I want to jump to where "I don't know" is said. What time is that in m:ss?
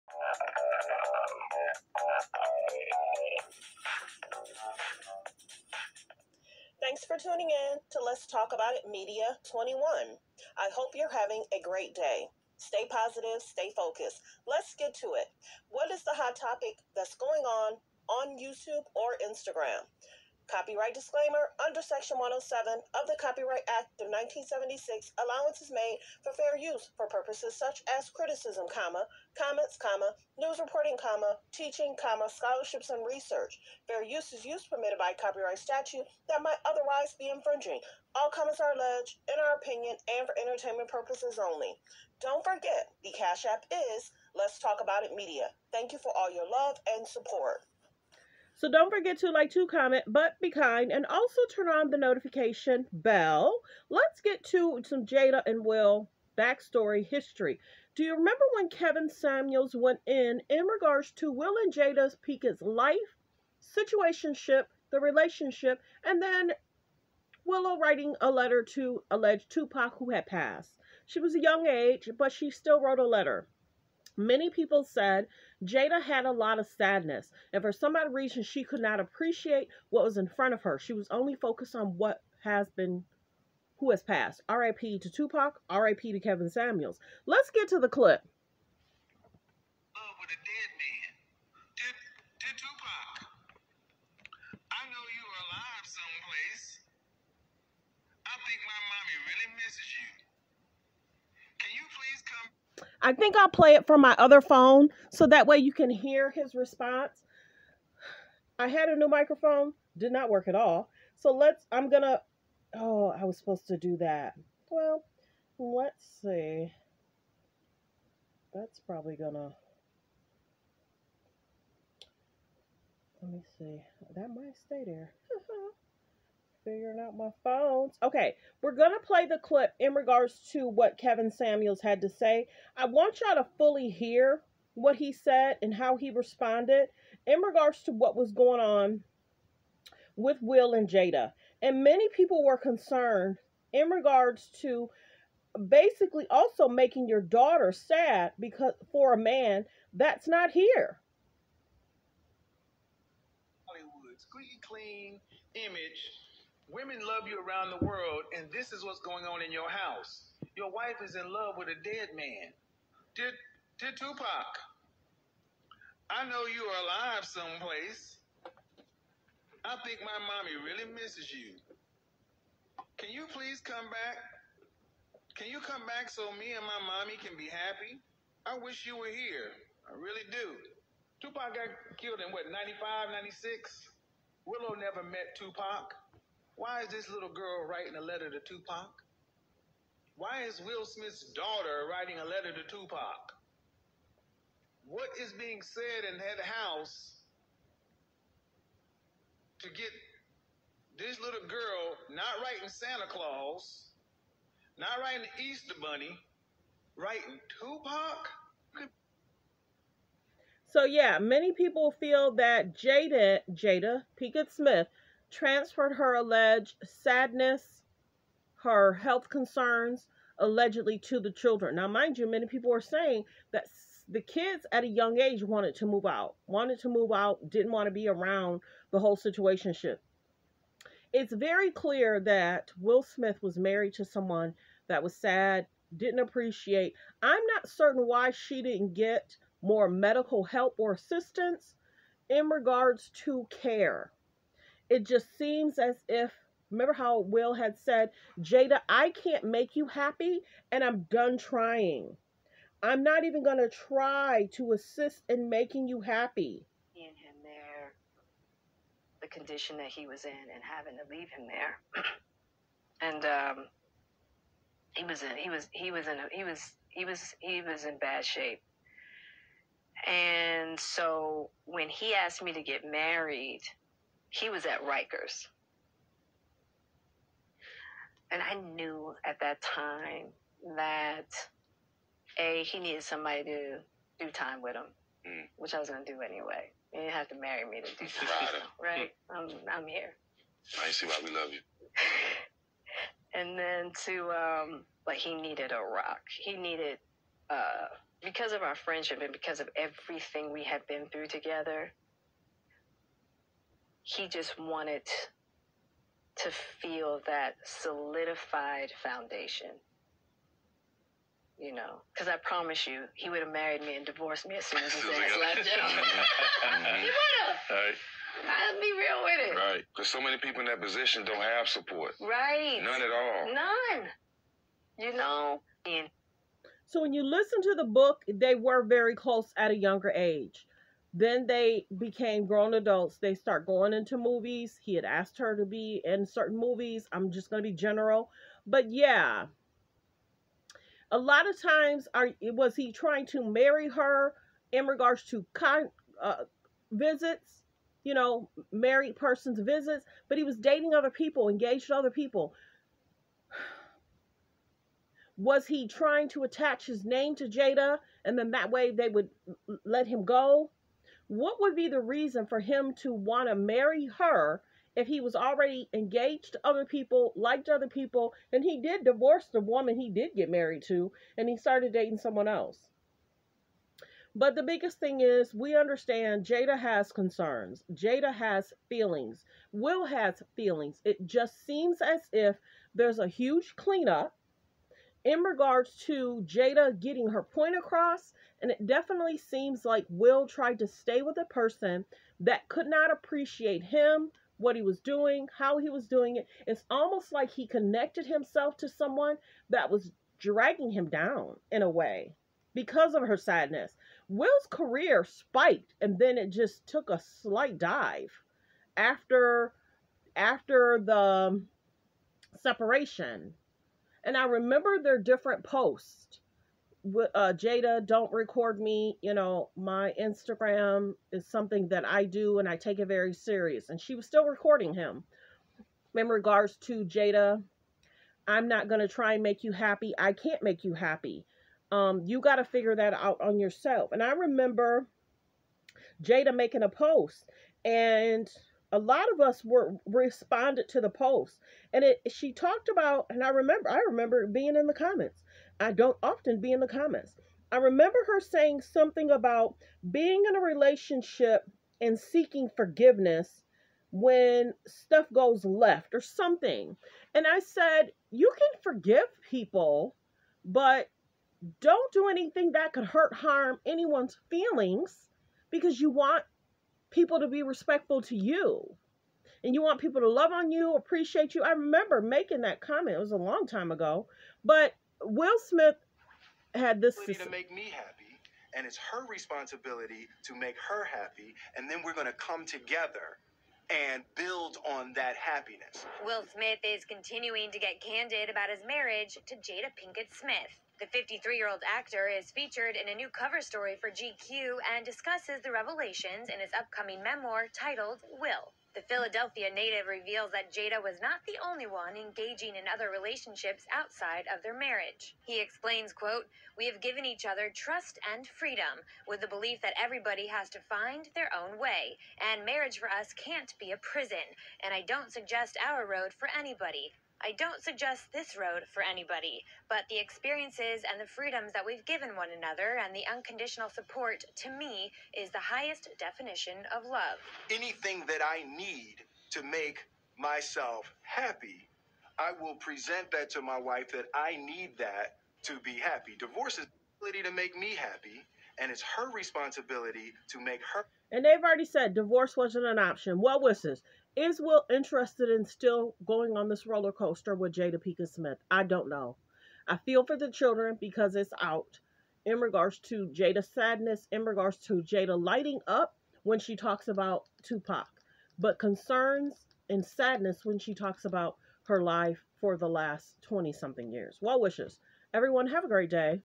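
9:08.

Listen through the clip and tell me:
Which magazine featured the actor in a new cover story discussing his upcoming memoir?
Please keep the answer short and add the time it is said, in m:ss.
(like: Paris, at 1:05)
GQ, at 8:14.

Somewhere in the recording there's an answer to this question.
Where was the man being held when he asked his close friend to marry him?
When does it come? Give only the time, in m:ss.
4:34.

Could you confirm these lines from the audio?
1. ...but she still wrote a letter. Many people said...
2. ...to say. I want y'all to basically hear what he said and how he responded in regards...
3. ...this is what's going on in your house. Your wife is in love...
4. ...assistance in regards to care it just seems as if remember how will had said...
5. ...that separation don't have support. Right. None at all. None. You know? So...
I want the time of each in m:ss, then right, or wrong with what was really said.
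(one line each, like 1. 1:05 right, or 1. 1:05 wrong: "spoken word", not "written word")
1. 1:12 right
2. 2:12 wrong: "fully", not "basically"
3. 2:38 right
4. 4:00 right
5. 5:20 wrong: "position", not "separation".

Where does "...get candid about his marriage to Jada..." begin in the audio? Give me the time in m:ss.
8:07.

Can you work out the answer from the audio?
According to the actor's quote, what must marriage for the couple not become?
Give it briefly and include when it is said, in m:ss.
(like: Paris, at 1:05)
a prison, at 8:33.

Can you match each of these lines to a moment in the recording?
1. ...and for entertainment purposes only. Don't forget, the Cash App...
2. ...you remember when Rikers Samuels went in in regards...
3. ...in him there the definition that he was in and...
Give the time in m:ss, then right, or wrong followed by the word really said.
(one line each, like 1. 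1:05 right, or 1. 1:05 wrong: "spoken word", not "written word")
1. 0:40 right
2. 0:58 wrong: "Kevin", not "Rikers"
3. 4:16 wrong: "condition", not "definition".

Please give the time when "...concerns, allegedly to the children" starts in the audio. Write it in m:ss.
3:39.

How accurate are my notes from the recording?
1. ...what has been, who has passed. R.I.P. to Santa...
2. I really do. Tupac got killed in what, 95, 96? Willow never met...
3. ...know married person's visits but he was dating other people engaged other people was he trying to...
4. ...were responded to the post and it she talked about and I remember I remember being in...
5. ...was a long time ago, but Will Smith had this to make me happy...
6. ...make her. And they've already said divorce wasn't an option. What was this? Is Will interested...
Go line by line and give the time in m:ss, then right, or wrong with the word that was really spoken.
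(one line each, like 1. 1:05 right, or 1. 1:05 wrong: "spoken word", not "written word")
1. 1:21 wrong: "Tupac", not "Santa"
2. 2:59 right
3. 5:48 right
4. 7:19 right
5. 7:53 right
6. 9:00 right.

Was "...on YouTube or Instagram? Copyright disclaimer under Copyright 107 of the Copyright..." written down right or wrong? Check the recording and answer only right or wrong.
wrong.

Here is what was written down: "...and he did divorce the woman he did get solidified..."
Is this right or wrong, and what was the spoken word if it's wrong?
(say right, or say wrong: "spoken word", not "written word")
wrong: "married", not "solidified".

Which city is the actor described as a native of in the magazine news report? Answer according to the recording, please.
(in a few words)
Philadelphia.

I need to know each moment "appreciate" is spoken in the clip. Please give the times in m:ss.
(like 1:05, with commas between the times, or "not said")
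1:18, 3:56, 6:33, 7:50.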